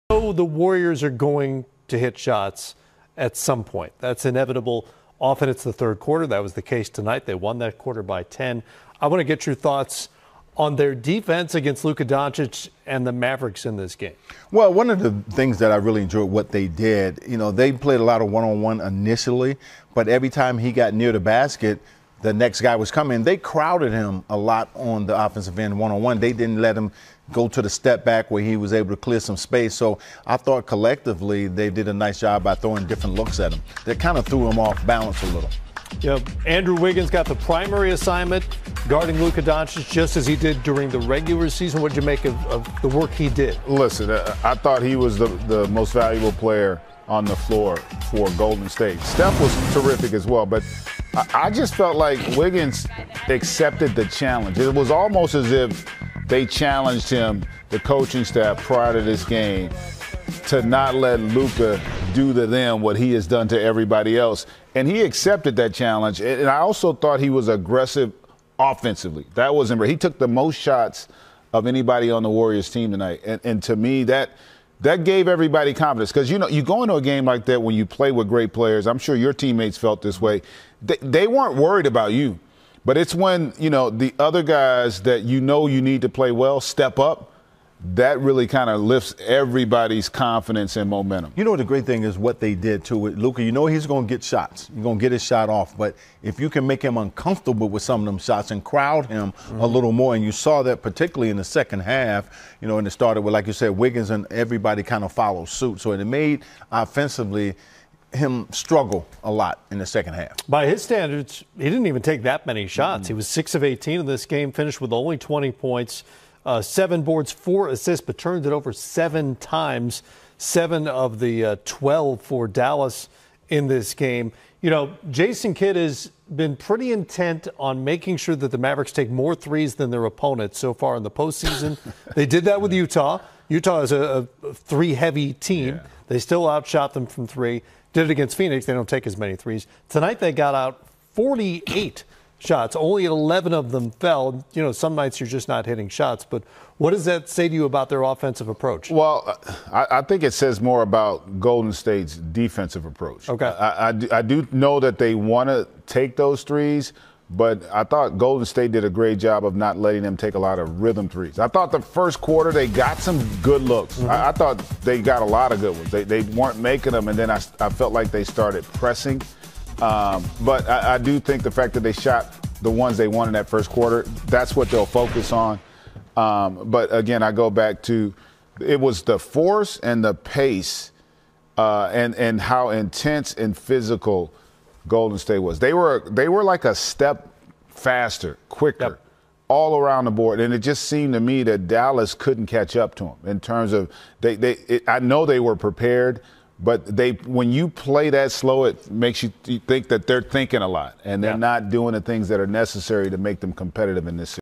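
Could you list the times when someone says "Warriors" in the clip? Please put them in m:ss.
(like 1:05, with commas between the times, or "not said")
0:00, 1:12.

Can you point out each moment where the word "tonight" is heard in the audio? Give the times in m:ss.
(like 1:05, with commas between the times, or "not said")
0:06, 1:12, 2:19.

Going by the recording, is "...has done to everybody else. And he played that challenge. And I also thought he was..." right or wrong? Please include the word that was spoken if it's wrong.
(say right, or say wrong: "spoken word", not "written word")
wrong: "accepted", not "played".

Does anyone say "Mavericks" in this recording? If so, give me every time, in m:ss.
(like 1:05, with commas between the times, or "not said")
0:13, 2:08.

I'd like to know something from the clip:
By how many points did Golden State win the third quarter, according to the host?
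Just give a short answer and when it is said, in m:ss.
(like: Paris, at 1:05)
10, at 0:08.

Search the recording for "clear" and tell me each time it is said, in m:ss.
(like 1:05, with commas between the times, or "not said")
0:28.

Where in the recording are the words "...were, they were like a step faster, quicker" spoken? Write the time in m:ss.
3:05.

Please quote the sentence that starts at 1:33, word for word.
You know, he's going to get shots.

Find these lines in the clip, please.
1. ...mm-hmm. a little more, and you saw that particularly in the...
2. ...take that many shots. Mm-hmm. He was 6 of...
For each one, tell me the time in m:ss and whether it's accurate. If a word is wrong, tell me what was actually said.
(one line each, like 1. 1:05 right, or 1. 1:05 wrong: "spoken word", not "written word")
1. 1:39 right
2. 1:52 right.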